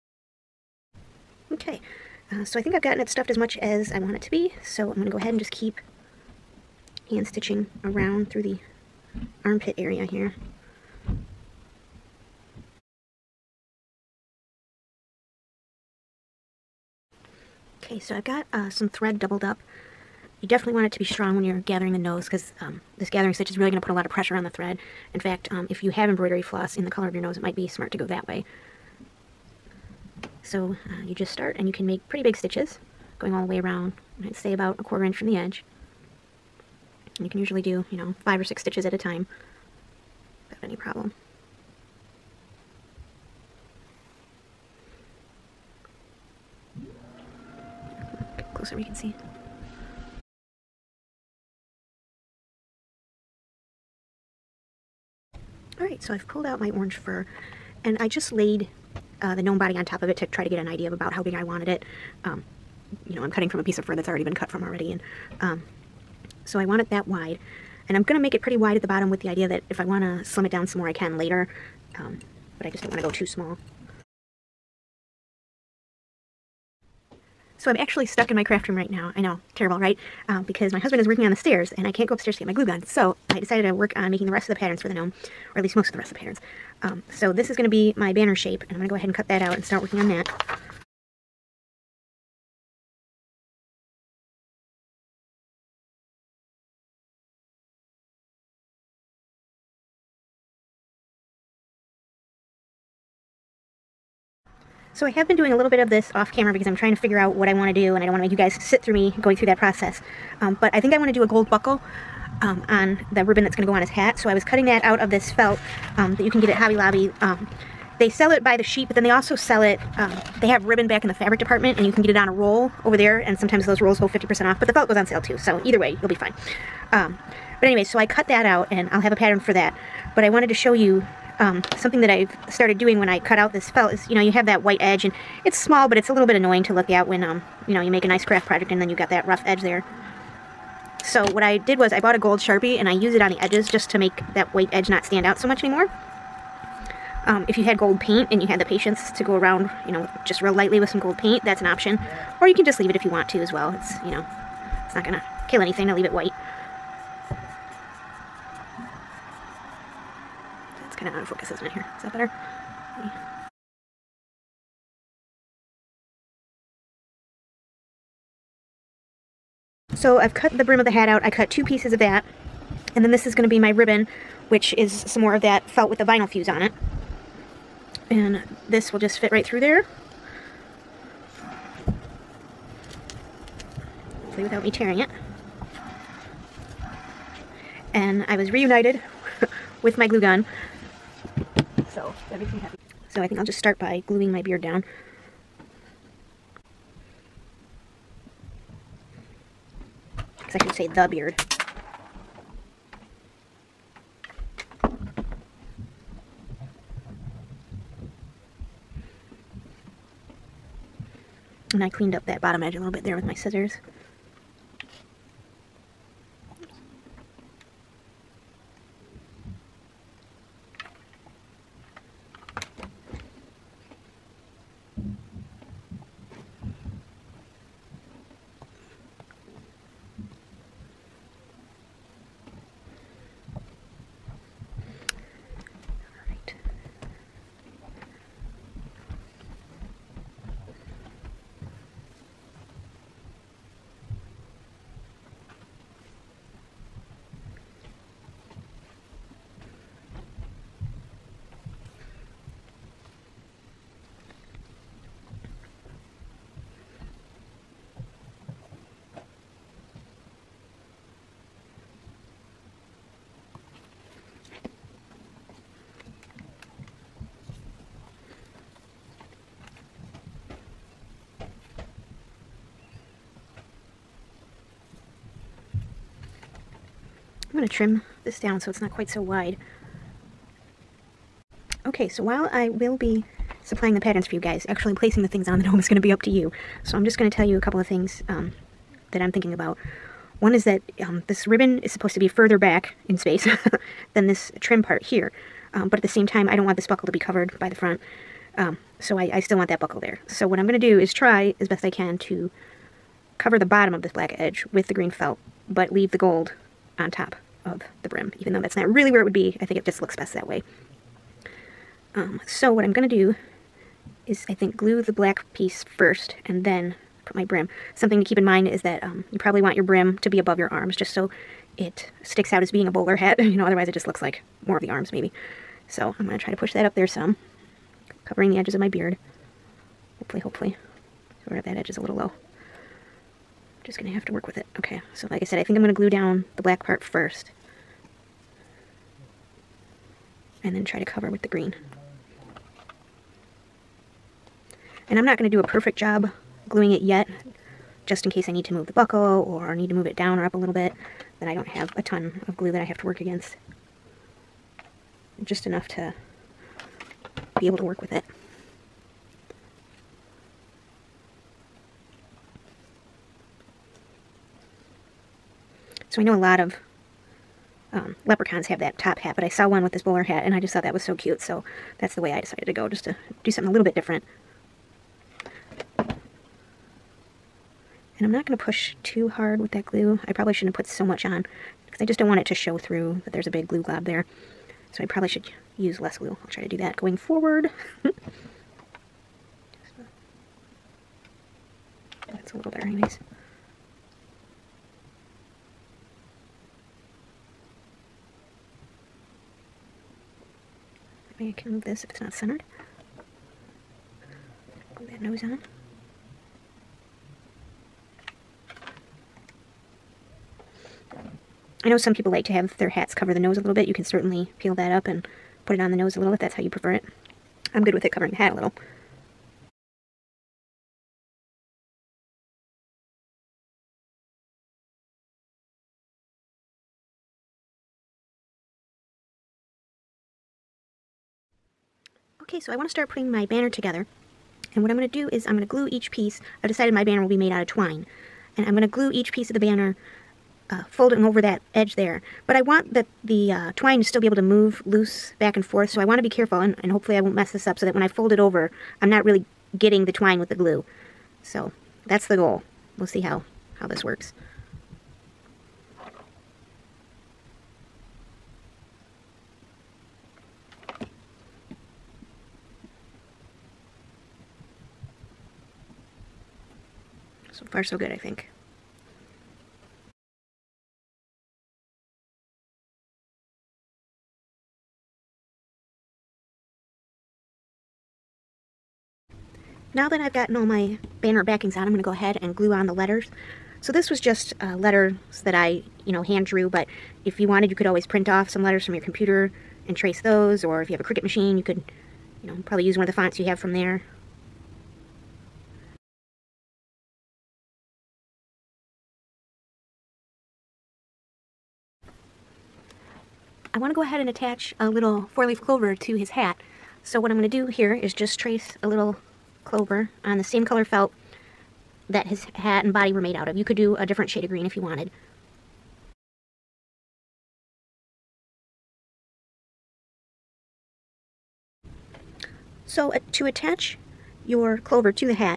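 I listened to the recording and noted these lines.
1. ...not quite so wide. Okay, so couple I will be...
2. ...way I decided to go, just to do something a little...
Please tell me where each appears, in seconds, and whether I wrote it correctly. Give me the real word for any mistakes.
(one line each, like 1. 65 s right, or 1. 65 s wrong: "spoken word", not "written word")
1. 278 s wrong: "while", not "couple"
2. 372 s right.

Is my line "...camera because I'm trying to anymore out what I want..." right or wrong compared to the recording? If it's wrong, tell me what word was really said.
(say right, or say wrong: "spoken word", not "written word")
wrong: "figure", not "anymore".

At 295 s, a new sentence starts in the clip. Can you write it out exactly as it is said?
Um, but at the same time, I don't want this buckle to be covered by the front.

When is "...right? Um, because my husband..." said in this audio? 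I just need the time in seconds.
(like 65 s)
79 s.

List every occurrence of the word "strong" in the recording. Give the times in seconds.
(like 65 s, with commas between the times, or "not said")
21 s.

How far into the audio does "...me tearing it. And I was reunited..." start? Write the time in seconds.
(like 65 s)
184 s.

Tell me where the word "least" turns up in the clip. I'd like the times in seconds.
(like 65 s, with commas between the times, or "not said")
85 s.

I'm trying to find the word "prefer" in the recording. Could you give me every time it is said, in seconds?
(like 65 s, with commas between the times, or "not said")
416 s.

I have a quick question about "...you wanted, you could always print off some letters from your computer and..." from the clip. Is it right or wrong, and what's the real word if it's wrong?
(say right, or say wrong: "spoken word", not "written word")
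right.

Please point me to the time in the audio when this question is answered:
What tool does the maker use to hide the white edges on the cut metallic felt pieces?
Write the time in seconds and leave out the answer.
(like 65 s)
142 s.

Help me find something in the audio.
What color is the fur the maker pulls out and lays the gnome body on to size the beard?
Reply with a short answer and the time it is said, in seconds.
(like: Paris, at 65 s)
orange, at 56 s.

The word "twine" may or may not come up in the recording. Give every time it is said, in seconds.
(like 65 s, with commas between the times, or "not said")
437 s, 443 s, 450 s.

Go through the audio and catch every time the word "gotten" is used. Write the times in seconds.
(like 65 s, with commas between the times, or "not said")
2 s, 480 s.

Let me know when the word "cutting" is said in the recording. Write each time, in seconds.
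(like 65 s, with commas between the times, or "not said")
63 s, 114 s.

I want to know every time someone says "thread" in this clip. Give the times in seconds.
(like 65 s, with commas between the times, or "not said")
18 s, 24 s.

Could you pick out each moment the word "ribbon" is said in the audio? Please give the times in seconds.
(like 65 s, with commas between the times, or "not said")
113 s, 120 s, 173 s, 291 s.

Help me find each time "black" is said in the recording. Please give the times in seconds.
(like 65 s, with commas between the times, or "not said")
304 s, 315 s, 336 s.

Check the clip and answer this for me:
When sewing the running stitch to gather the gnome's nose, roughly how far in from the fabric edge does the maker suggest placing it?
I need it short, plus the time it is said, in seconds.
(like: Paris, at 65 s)
a quarter inch, at 34 s.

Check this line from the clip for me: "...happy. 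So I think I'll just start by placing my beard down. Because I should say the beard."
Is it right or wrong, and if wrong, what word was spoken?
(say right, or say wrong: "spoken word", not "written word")
wrong: "gluing", not "placing".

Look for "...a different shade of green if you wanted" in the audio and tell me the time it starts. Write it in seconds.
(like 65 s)
513 s.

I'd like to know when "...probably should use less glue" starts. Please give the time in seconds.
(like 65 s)
385 s.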